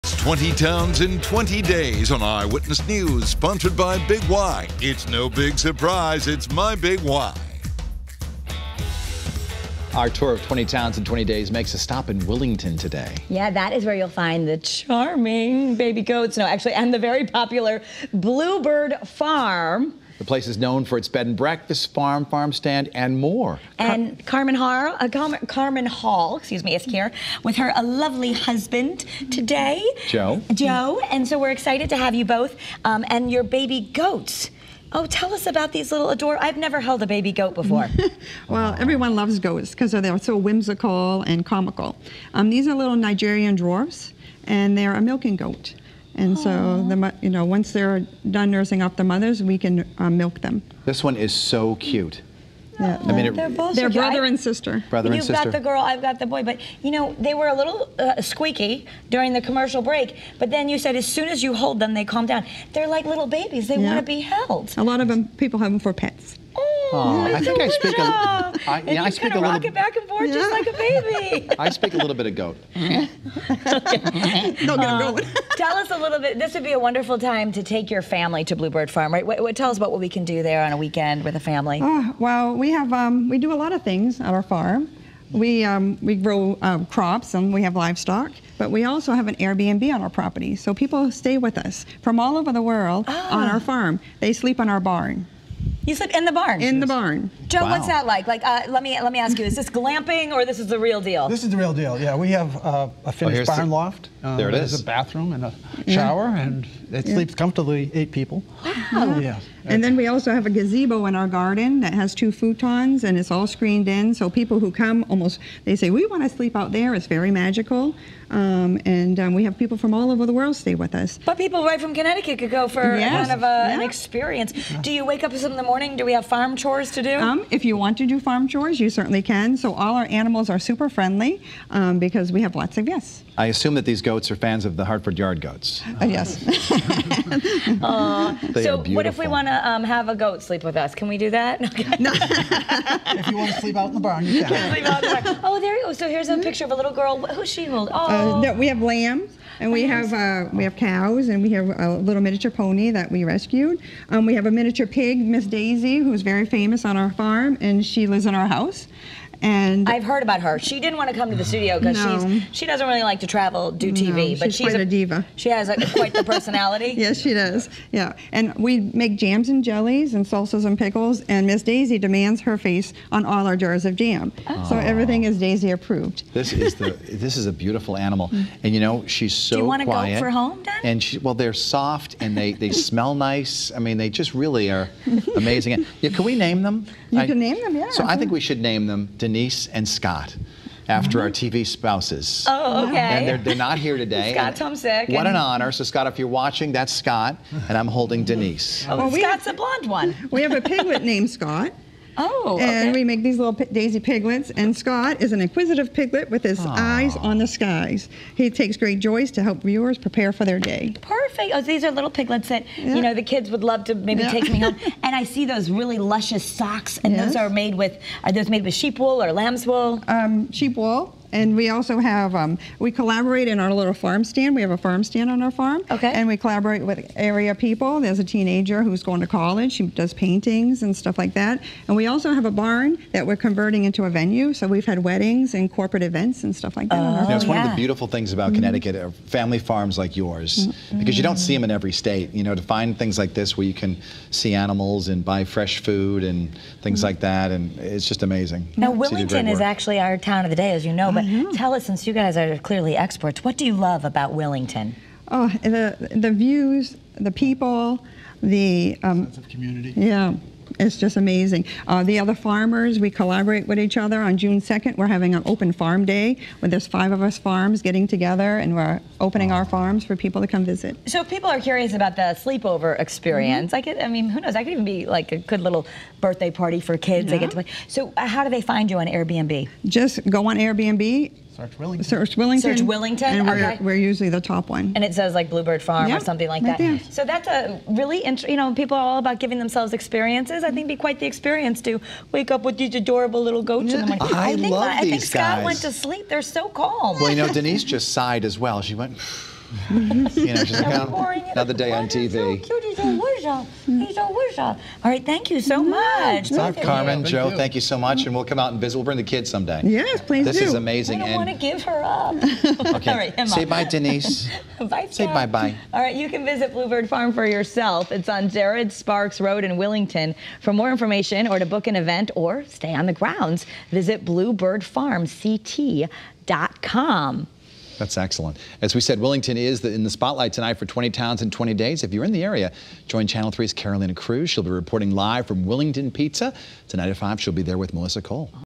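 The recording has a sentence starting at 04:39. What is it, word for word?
Just go on Airbnb, Search Willington.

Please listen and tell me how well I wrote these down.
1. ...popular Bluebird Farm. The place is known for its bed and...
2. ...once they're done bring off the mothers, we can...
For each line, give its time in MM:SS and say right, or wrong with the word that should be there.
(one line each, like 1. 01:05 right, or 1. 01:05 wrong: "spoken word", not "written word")
1. 00:17 right
2. 00:47 wrong: "nursing", not "bring".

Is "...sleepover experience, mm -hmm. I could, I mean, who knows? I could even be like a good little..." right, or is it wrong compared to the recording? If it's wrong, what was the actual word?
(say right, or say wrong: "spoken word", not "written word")
right.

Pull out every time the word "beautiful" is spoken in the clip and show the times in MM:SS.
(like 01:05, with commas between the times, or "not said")
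02:57, 03:57.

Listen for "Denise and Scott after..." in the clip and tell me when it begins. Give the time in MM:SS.
03:09.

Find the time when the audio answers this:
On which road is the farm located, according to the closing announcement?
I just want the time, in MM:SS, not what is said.
05:18.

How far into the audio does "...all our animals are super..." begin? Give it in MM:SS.
02:09.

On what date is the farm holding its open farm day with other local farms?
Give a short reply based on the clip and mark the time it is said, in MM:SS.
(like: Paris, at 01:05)
June 2, at 04:24.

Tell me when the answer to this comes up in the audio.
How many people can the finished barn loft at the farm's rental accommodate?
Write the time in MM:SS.
01:47.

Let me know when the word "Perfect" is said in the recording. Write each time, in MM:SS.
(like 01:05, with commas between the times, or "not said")
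03:31.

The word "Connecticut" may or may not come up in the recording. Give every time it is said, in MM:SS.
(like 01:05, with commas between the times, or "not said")
02:01, 03:58.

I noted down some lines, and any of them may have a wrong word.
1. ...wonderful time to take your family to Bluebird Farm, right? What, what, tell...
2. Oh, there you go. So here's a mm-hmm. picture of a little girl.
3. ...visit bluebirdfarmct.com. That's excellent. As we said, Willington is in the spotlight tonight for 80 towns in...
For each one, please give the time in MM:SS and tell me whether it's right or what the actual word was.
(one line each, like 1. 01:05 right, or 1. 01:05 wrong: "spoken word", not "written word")
1. 01:16 right
2. 02:25 right
3. 05:23 wrong: "20", not "80".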